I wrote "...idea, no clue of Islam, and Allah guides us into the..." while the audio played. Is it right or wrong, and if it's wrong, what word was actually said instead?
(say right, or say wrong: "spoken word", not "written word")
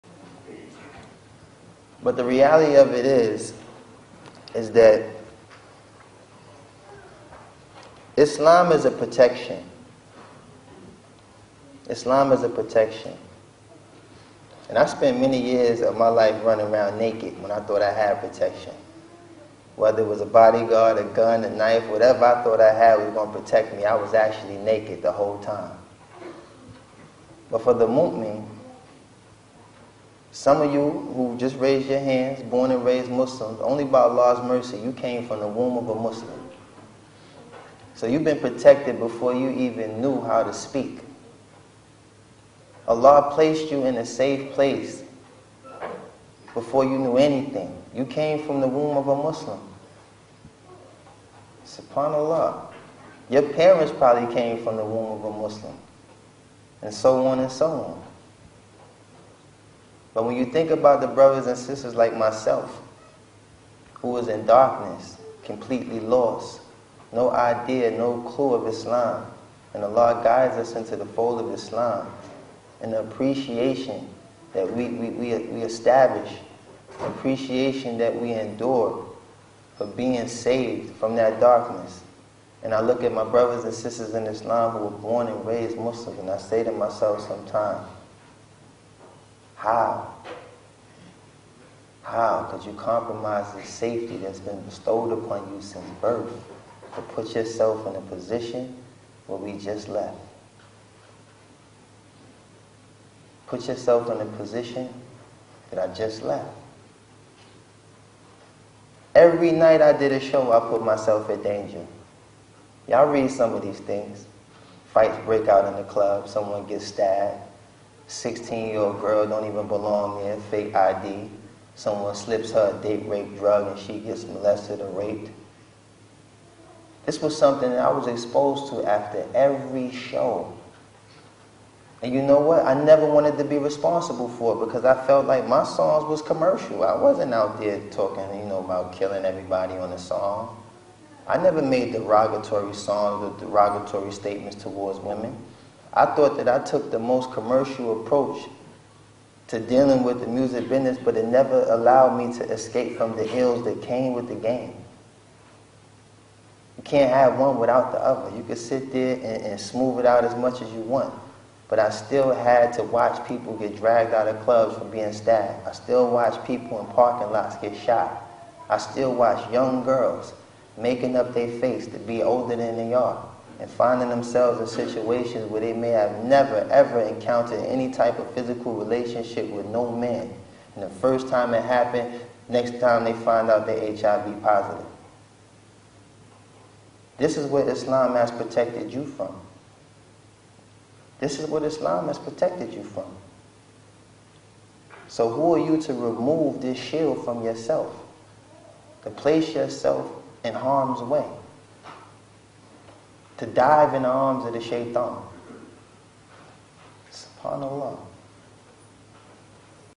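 right.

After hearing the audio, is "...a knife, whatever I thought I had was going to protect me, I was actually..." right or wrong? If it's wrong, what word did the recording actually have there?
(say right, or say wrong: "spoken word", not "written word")
right.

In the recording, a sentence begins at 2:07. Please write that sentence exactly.
This was something that I was exposed to after every show.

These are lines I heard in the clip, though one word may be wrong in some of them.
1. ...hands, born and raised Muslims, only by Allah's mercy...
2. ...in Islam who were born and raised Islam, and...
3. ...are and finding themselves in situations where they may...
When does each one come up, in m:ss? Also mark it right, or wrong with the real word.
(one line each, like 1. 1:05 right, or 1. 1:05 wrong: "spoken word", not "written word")
1. 0:31 right
2. 1:24 wrong: "Muslims", not "Islam"
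3. 2:52 right.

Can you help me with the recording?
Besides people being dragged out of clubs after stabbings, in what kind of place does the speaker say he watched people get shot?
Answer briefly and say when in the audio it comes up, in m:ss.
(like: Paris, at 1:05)
parking lots, at 2:46.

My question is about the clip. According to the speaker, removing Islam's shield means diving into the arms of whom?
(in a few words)
Shaitan.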